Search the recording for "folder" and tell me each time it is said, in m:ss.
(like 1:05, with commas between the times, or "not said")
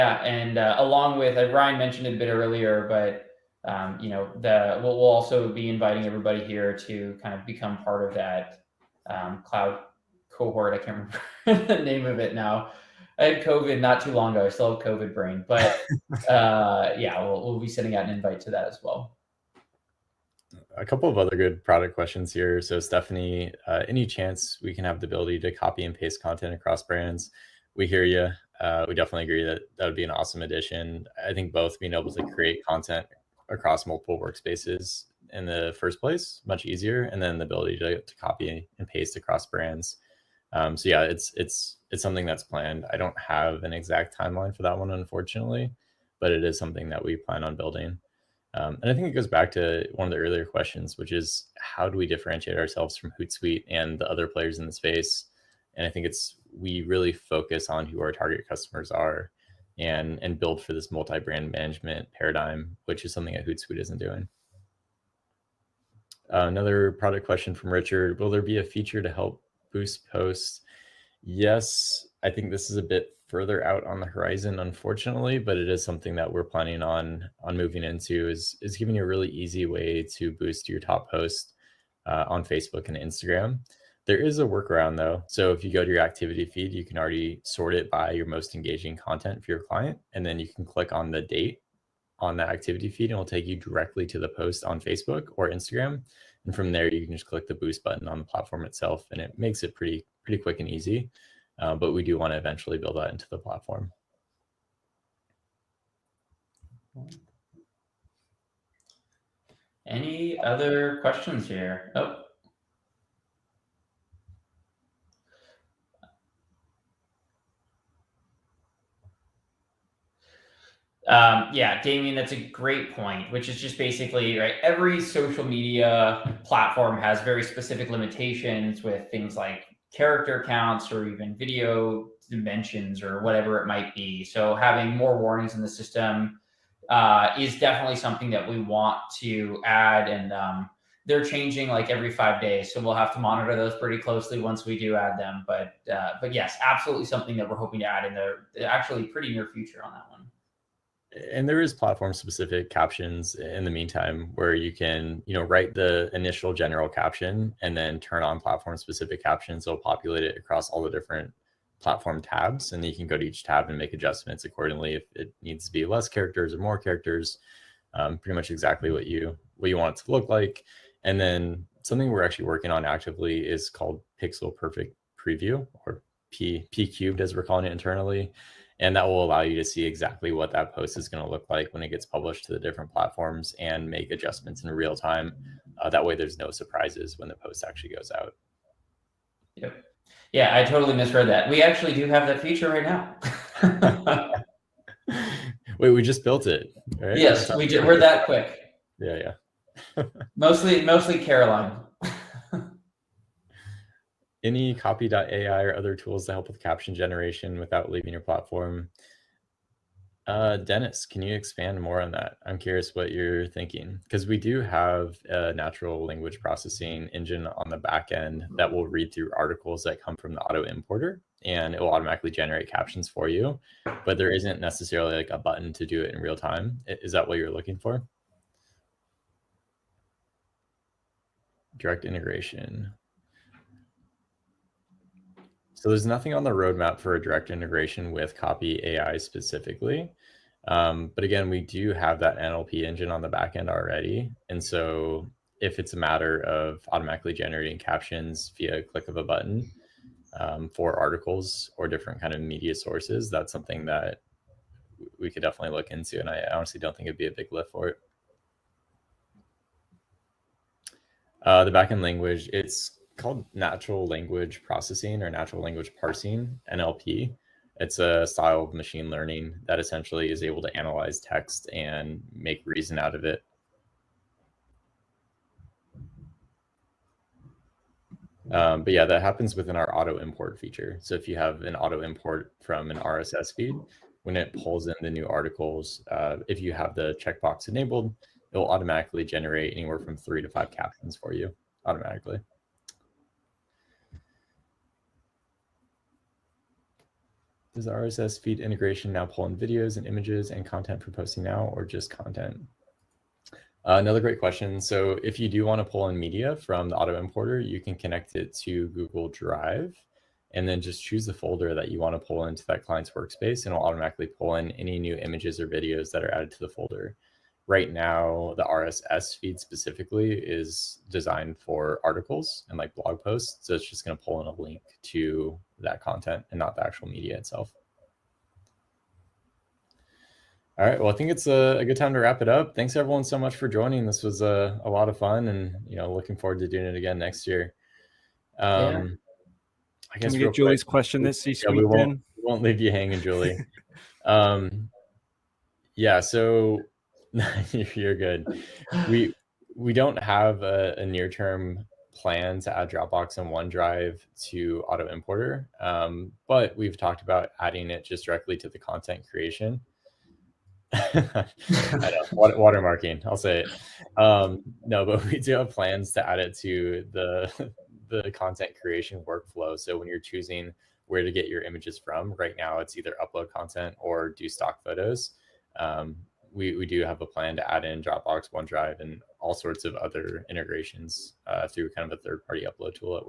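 5:11, 5:16.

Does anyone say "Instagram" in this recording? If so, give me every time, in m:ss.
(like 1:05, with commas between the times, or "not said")
1:22, 1:35.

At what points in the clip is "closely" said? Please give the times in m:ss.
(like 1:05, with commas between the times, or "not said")
2:23.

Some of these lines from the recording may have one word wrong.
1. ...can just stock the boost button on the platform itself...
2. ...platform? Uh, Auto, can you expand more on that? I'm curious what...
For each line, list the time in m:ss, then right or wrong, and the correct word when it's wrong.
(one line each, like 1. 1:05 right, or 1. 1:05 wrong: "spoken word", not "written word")
1. 1:37 wrong: "click", not "stock"
2. 3:28 wrong: "Dennis", not "Auto".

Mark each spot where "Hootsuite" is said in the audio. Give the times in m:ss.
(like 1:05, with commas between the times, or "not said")
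0:53, 1:03.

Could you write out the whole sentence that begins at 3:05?
Uh, that way, there's no surprises when the post actually goes out.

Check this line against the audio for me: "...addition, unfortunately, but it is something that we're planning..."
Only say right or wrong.
wrong.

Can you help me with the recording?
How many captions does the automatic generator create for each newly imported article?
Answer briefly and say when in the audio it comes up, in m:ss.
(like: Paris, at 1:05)
3 to 5, at 4:50.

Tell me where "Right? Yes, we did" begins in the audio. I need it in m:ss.
3:16.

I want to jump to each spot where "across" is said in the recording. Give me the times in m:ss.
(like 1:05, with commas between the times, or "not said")
0:26, 0:33, 0:39, 2:40.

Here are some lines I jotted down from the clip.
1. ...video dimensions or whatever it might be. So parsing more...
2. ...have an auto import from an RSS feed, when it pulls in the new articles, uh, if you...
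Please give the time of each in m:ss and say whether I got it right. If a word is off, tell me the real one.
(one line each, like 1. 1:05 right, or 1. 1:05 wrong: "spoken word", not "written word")
1. 2:11 wrong: "having", not "parsing"
2. 4:41 right.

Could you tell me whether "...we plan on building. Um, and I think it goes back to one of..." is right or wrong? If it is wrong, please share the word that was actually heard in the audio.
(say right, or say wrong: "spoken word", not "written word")
right.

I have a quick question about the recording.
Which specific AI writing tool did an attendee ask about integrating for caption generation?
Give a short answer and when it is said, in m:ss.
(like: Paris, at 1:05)
Copy AI, at 3:58.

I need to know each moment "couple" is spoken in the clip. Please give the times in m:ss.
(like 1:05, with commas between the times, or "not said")
0:20.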